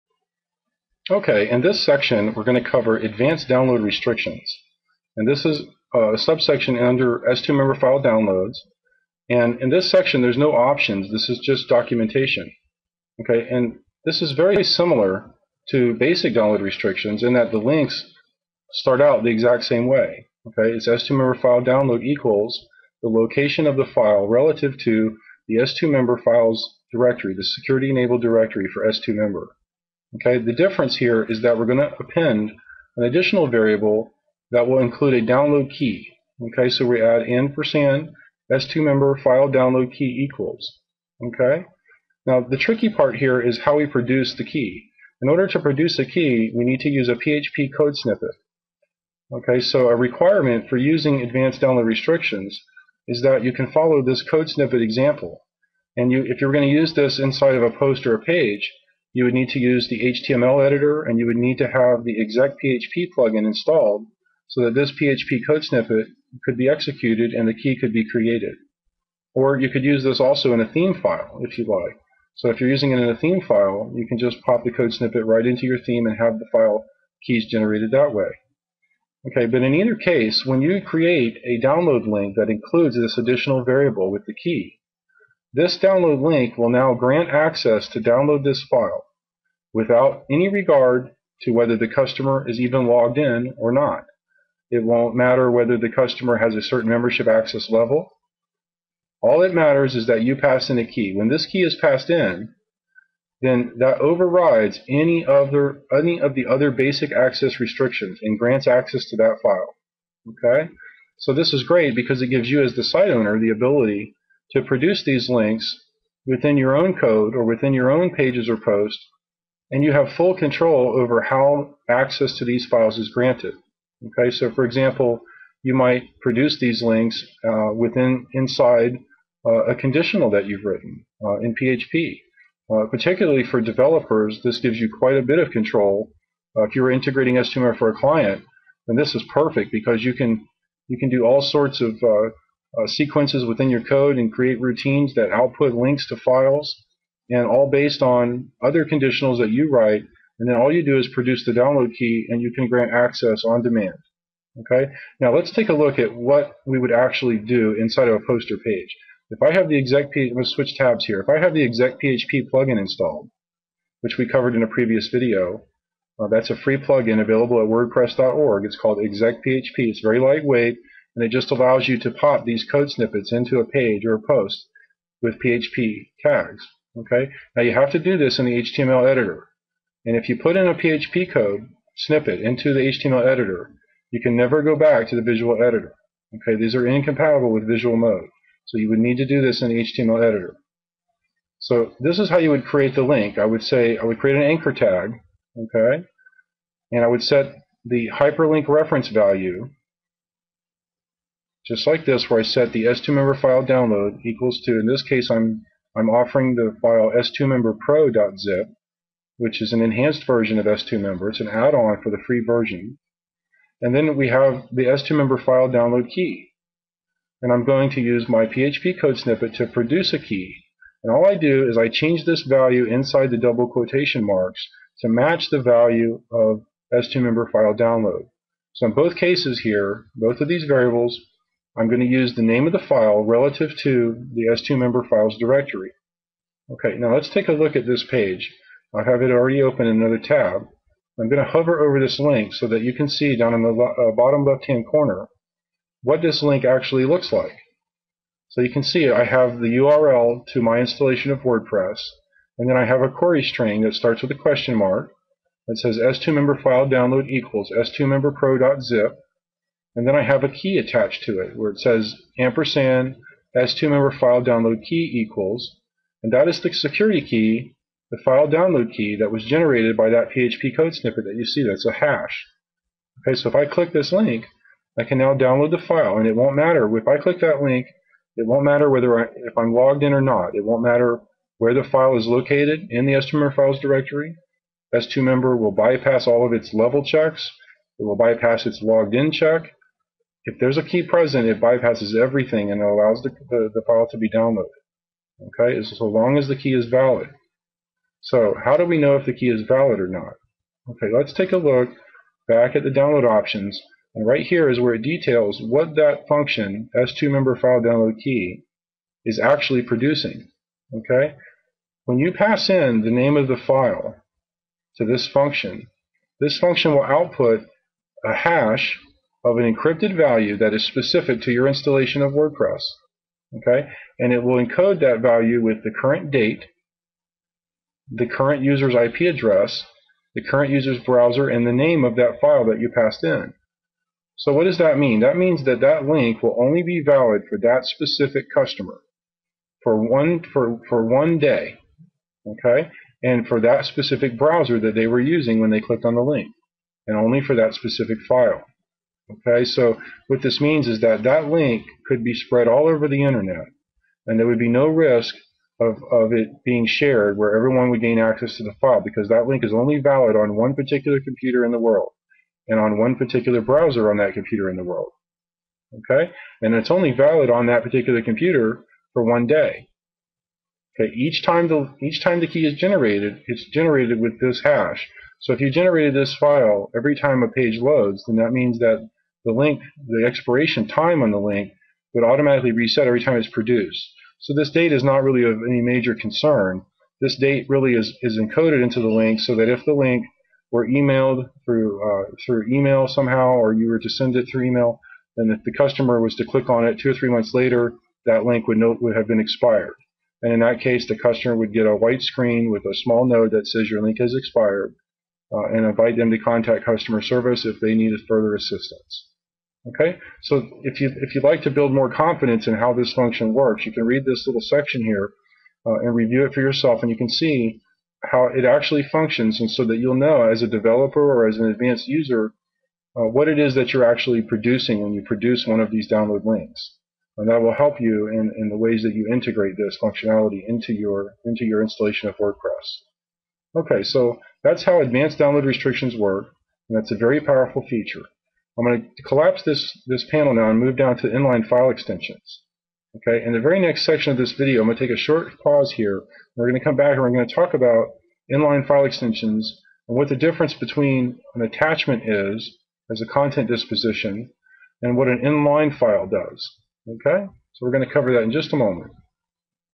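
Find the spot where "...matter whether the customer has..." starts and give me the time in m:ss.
1:35.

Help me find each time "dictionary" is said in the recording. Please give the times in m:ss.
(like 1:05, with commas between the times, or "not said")
not said.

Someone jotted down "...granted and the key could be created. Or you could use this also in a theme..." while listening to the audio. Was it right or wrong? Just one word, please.
wrong.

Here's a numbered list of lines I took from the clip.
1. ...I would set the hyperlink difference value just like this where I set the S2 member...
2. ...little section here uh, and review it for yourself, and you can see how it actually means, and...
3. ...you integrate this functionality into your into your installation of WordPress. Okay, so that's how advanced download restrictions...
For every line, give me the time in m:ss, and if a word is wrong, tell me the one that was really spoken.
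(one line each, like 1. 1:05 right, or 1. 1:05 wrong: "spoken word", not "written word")
1. 3:17 wrong: "reference", not "difference"
2. 6:54 wrong: "functions", not "means"
3. 7:09 right.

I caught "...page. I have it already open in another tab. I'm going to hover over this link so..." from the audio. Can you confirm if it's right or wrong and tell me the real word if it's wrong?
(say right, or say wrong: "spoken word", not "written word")
right.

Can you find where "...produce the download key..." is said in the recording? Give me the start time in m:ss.
2:31.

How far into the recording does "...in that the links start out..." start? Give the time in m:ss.
0:17.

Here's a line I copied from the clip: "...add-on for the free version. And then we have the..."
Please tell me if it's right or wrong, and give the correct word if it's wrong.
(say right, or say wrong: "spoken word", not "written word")
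right.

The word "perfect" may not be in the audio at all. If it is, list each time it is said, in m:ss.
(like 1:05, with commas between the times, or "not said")
2:19.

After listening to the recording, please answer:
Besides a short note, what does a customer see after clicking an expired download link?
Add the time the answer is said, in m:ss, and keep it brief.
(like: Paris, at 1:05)
a white screen, at 6:41.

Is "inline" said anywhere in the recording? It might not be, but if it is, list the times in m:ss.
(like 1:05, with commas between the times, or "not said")
7:21, 7:28, 7:35.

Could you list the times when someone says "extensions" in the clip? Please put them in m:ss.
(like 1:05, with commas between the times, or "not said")
7:21, 7:29.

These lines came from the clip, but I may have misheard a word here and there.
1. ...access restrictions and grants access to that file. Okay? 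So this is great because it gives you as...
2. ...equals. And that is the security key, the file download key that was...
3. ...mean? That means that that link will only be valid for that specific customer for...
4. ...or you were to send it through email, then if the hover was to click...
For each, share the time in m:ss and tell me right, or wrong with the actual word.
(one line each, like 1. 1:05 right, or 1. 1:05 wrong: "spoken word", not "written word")
1. 1:47 right
2. 4:25 right
3. 5:34 right
4. 6:33 wrong: "customer", not "hover".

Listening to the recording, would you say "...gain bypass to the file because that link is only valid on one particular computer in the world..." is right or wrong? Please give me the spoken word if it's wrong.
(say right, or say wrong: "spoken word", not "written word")
wrong: "access", not "bypass".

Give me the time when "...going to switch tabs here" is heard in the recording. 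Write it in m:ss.
2:40.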